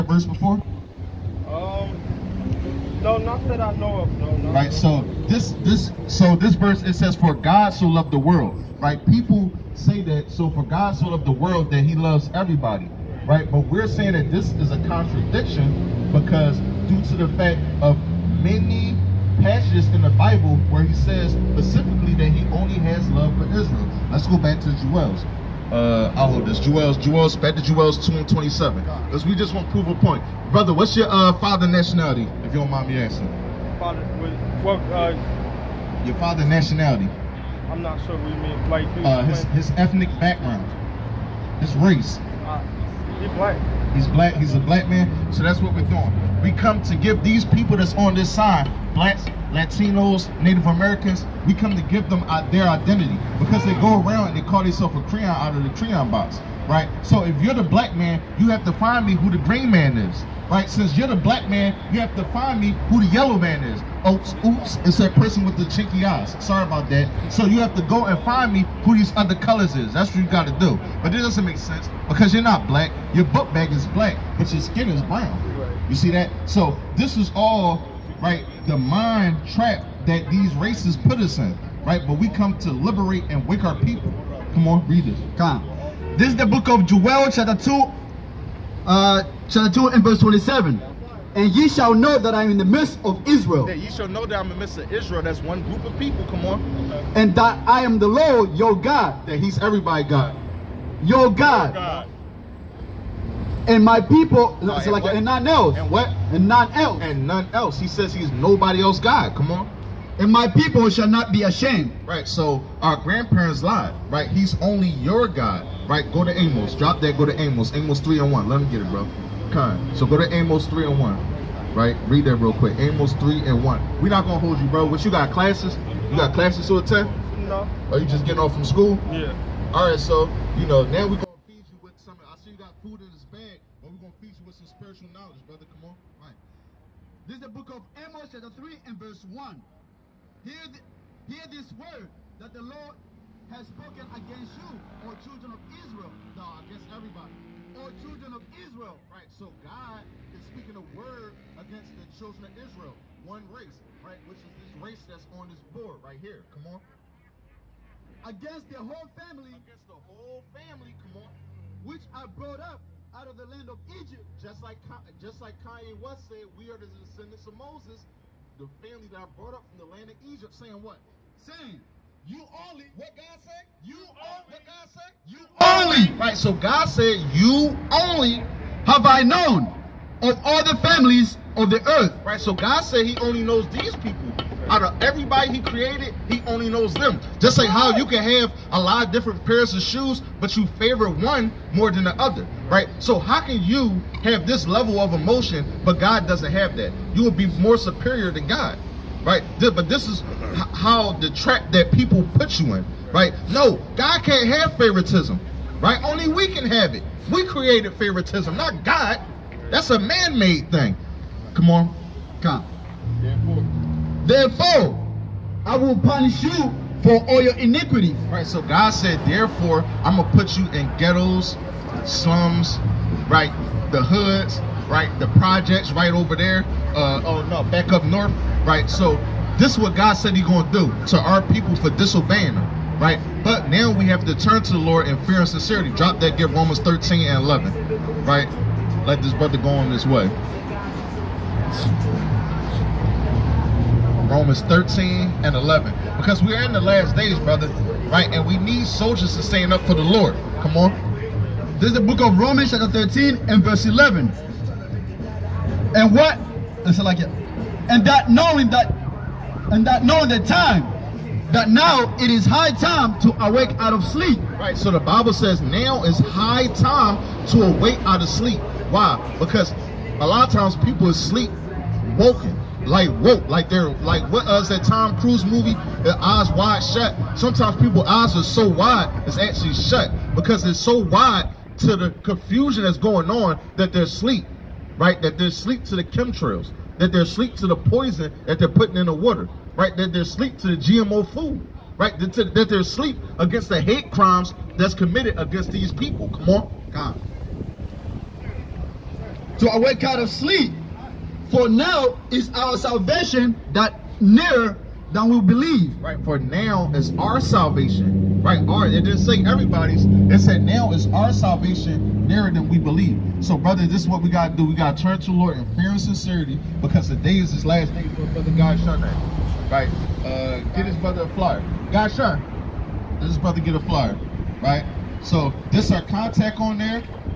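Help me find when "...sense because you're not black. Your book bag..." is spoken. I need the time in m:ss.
1:11.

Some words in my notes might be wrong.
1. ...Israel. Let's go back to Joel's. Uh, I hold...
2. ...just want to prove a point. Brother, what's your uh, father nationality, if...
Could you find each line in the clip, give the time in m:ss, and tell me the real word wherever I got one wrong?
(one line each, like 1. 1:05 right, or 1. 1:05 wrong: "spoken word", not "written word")
1. 0:23 right
2. 0:29 right.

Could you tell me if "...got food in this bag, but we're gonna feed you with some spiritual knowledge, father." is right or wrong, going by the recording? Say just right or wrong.
wrong.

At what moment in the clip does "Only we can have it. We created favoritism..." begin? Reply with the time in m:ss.
3:26.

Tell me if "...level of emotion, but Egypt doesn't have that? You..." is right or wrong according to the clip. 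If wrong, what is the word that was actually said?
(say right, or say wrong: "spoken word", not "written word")
wrong: "God", not "Egypt".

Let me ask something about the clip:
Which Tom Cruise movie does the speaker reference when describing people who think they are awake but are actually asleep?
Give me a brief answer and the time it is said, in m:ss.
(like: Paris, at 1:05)
Eyes Wide Shut, at 4:36.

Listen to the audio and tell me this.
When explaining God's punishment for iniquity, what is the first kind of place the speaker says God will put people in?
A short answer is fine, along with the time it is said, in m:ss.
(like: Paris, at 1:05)
ghettos, at 3:40.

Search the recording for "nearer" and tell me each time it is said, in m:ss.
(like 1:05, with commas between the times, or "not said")
5:04, 5:12.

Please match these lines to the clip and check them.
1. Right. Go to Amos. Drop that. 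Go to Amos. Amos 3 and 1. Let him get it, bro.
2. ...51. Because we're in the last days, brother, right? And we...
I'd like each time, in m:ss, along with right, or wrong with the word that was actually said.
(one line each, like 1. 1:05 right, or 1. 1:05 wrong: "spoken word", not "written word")
1. 1:55 right
2. 4:05 wrong: "11", not "51".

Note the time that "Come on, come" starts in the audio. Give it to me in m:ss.
3:31.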